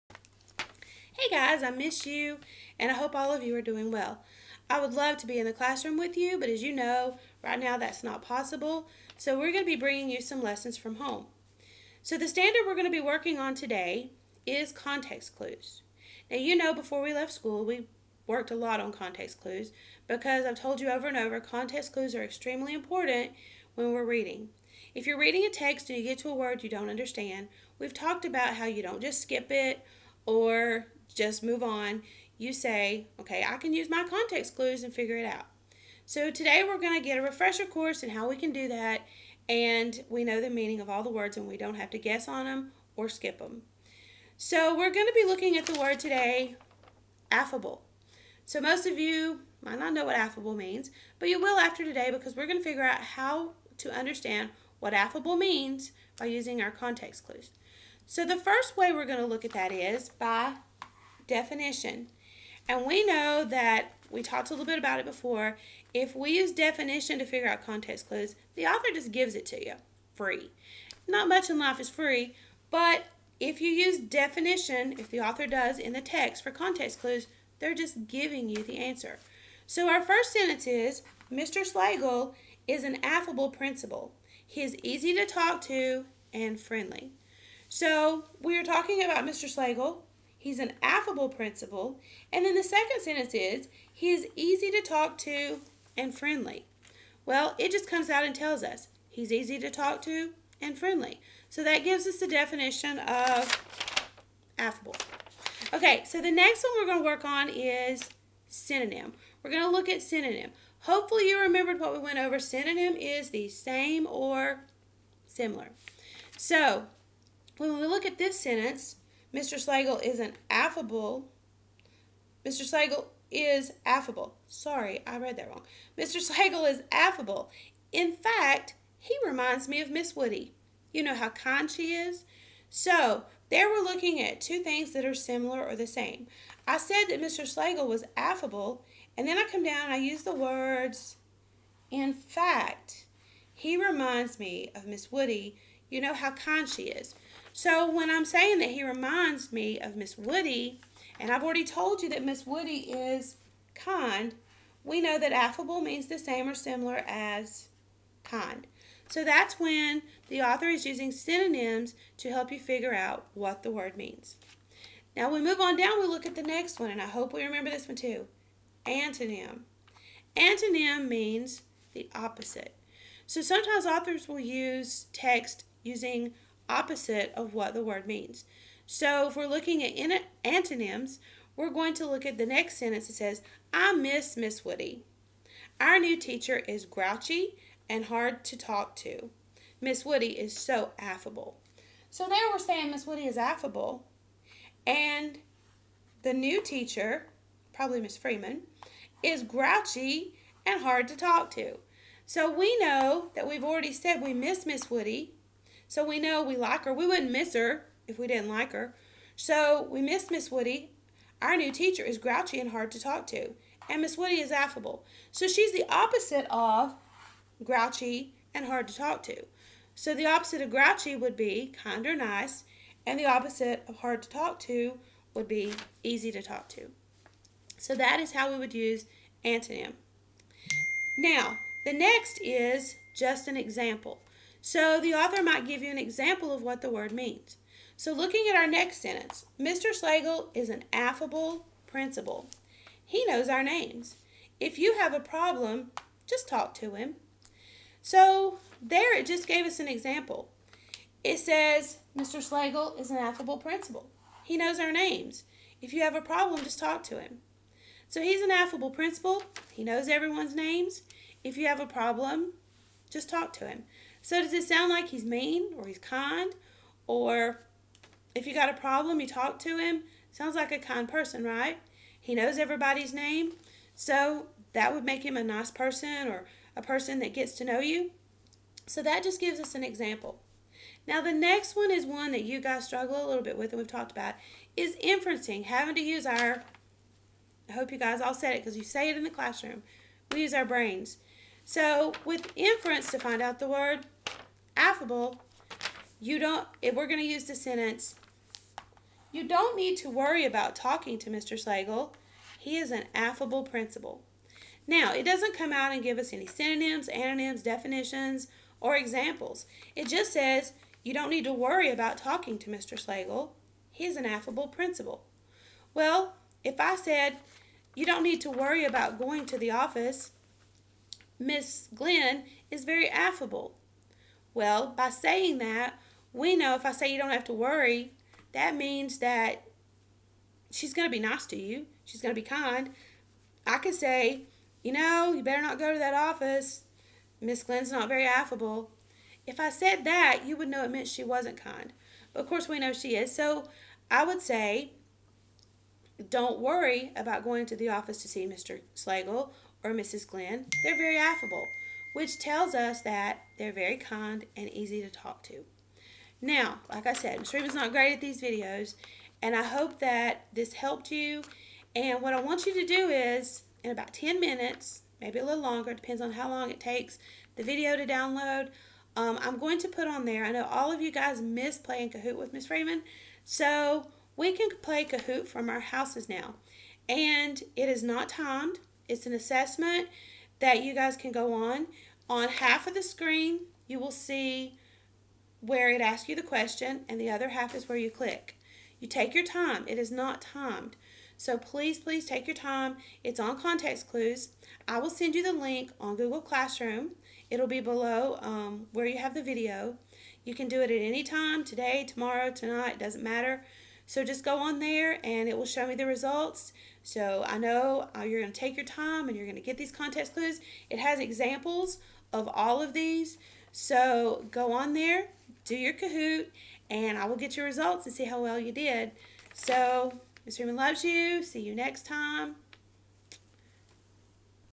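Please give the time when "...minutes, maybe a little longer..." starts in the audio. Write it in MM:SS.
06:04.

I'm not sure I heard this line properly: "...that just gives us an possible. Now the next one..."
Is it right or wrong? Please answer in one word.
wrong.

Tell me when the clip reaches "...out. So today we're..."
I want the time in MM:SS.
00:35.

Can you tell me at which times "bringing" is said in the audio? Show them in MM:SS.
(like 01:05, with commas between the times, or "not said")
00:09.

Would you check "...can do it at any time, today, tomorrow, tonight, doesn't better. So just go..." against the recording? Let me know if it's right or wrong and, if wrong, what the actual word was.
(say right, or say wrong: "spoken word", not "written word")
wrong: "matter", not "better".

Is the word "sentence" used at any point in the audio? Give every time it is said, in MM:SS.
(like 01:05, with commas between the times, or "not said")
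01:20, 01:33, 01:58, 03:02, 03:59, 04:57.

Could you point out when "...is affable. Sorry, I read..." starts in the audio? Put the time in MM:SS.
02:03.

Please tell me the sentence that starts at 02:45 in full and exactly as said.
Now we move on down, we look at the next one, and I hope we remember this one too.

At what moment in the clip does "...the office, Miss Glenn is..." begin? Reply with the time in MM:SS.
05:19.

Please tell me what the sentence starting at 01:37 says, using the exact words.
Well, it just comes out and tells us he's easy to talk to and friendly.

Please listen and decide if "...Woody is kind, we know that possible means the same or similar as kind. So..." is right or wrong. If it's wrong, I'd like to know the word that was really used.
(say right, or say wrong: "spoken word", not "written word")
wrong: "affable", not "possible".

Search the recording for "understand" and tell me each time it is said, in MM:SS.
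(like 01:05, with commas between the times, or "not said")
00:26, 00:53.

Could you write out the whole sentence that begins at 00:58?
So the first way we're going to look at that is by definition.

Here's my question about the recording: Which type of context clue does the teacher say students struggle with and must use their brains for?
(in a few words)
inferencing.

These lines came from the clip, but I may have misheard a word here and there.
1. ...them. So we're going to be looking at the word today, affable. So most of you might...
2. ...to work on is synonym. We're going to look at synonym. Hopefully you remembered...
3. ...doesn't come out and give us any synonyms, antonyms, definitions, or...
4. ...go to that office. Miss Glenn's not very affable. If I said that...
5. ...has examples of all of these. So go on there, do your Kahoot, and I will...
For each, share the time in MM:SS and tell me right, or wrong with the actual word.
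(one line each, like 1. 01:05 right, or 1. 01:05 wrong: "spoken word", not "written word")
1. 00:43 right
2. 01:47 right
3. 05:05 right
4. 05:35 right
5. 06:50 right.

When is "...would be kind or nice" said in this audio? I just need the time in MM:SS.
03:41.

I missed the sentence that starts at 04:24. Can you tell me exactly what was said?
So does it sound like he's mean or he's kind?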